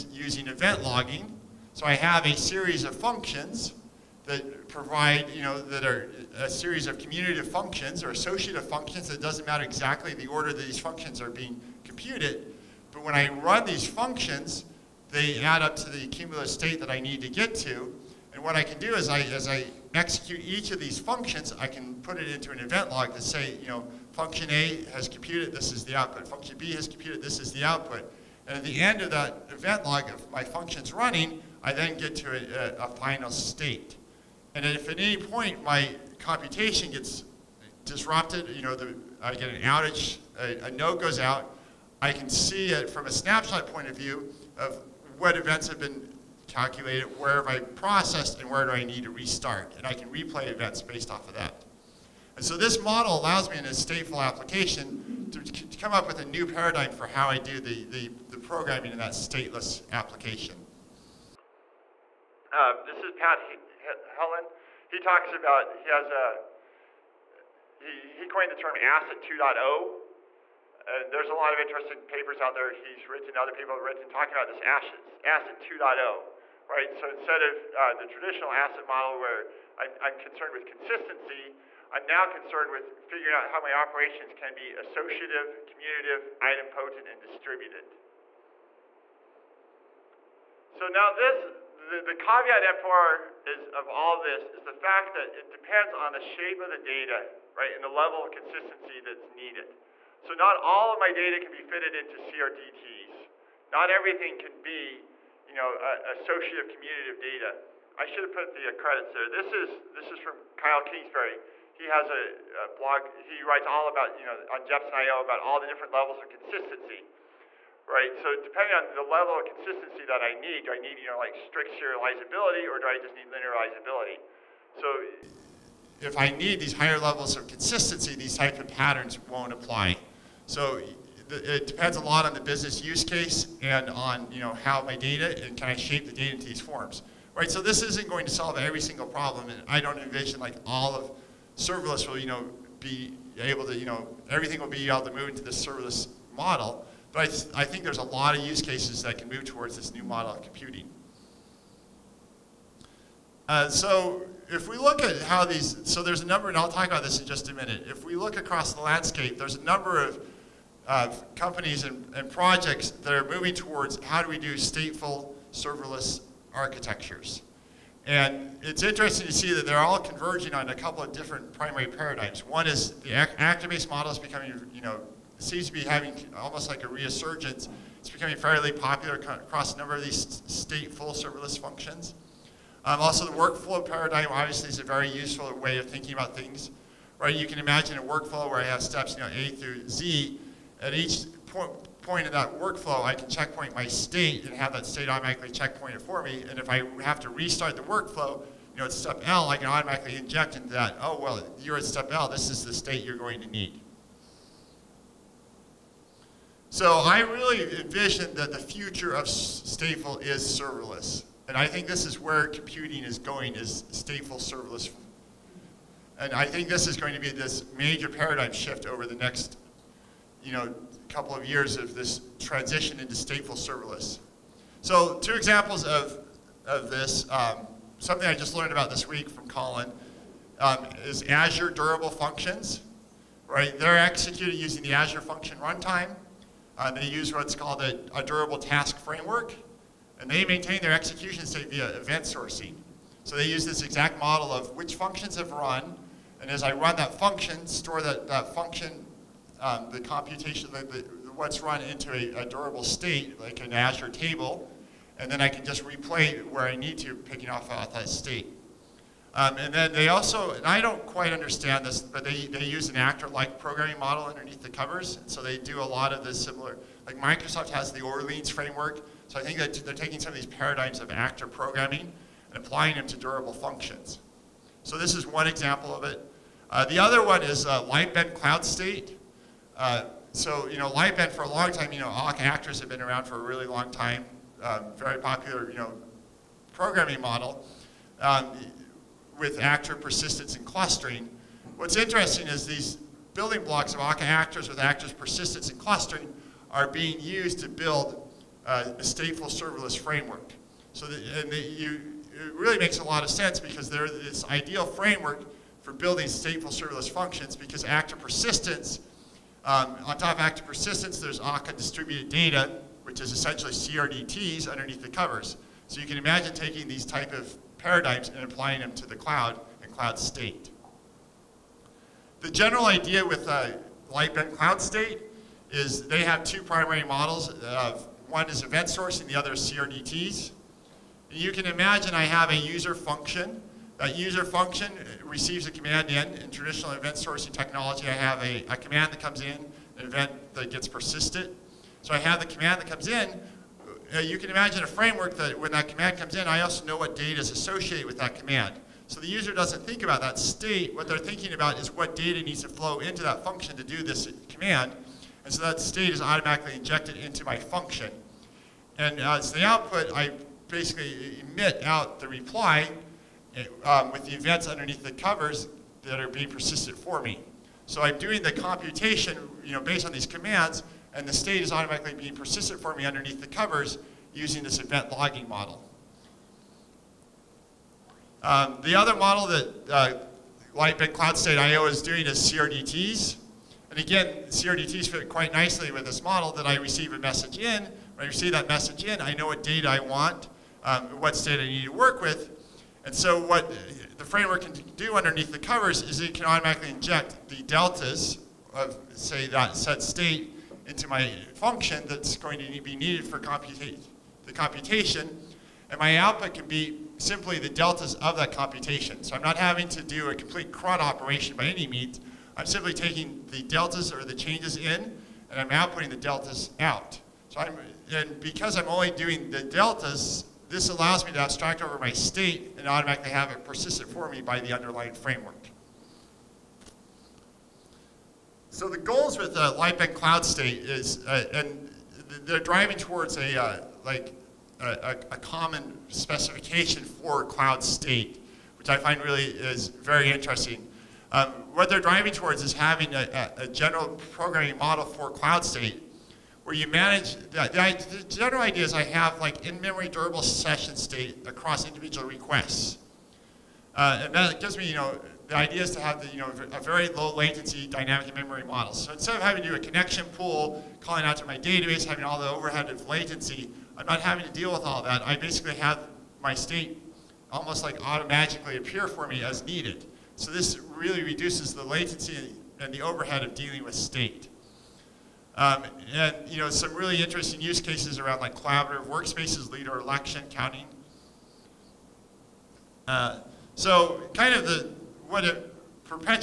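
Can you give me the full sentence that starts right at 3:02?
Um, also, the workflow paradigm obviously is a very useful way of thinking about things.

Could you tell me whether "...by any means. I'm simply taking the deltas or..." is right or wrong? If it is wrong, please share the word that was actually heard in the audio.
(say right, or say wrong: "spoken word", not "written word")
right.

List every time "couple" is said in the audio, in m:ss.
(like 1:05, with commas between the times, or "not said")
2:50, 3:41.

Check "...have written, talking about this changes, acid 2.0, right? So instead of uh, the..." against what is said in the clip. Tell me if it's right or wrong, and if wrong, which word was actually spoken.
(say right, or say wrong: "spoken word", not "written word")
wrong: "ashes", not "changes".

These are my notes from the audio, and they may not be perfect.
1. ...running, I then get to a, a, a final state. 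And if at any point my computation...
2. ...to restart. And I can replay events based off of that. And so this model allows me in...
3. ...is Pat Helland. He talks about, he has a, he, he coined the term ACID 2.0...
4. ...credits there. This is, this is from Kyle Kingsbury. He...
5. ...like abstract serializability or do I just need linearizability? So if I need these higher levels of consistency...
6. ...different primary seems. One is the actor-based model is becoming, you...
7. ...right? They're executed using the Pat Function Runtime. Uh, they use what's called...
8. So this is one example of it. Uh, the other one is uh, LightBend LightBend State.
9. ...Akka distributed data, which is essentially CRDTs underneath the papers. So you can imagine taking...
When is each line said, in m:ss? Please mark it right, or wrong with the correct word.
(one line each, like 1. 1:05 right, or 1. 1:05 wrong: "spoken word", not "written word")
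1. 0:30 right
2. 0:49 right
3. 1:03 right
4. 1:48 right
5. 2:01 wrong: "strict", not "abstract"
6. 2:51 wrong: "paradigms", not "seems"
7. 3:53 wrong: "Azure", not "Pat"
8. 4:34 wrong: "Cloud", not "LightBend"
9. 5:11 wrong: "covers", not "papers".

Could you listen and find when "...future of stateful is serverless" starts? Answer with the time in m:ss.
3:28.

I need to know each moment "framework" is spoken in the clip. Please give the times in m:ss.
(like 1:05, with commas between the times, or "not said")
3:58, 4:28, 4:59, 5:04, 5:44, 6:34, 7:05.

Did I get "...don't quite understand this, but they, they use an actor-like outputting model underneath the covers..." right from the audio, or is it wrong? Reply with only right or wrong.
wrong.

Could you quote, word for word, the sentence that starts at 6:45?
And my output can be simply the deltas of that computation.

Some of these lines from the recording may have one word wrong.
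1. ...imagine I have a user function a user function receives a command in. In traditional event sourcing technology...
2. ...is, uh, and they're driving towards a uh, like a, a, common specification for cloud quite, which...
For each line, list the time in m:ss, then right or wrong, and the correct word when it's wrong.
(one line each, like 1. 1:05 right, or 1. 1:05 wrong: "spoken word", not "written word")
1. 5:31 right
2. 7:10 wrong: "state", not "quite".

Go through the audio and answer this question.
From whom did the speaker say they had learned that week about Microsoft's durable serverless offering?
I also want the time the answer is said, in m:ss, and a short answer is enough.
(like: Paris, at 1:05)
Colin, at 3:49.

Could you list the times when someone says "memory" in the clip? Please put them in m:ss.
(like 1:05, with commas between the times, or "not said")
7:29, 7:38.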